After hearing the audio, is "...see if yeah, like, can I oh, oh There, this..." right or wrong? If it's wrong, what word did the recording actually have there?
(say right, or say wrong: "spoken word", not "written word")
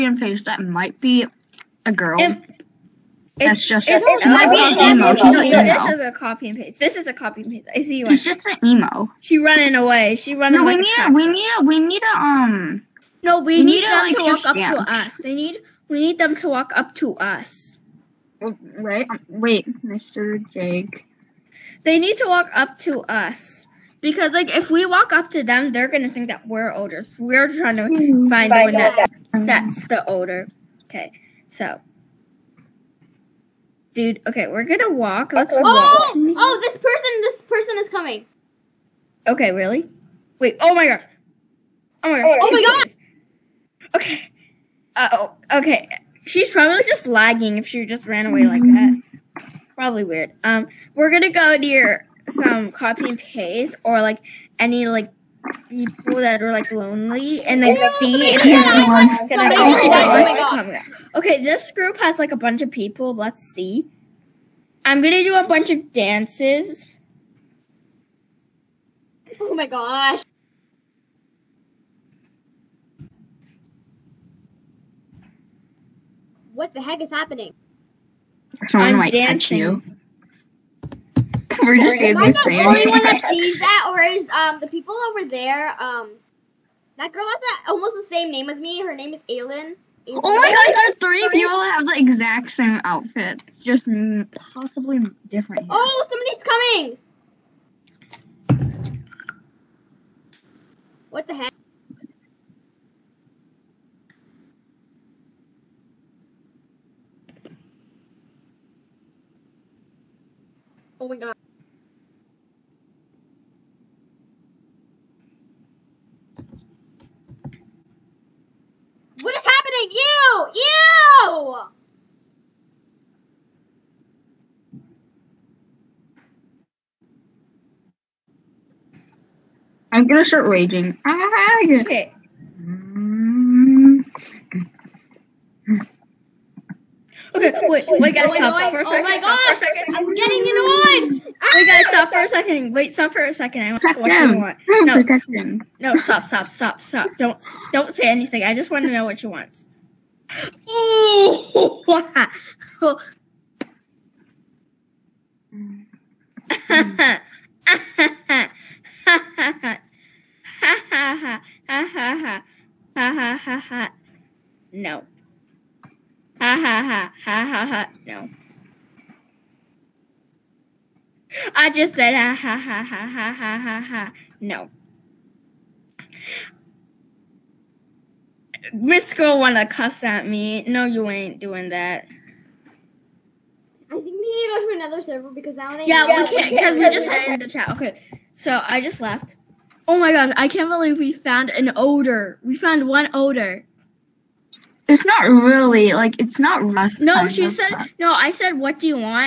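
wrong: "Okay", not "There".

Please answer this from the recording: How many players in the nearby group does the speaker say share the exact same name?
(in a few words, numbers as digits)
3.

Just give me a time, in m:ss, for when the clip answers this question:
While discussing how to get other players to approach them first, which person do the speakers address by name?
0:20.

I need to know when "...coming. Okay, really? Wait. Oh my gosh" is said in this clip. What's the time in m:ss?
0:37.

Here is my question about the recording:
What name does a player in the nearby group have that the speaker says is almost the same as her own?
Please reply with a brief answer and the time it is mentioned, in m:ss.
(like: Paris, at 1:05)
Aylin, at 1:29.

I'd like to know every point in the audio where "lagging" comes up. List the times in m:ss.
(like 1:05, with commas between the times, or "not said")
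0:47.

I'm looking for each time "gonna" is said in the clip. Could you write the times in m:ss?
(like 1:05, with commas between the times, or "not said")
0:25, 0:34, 0:51, 1:05, 2:10.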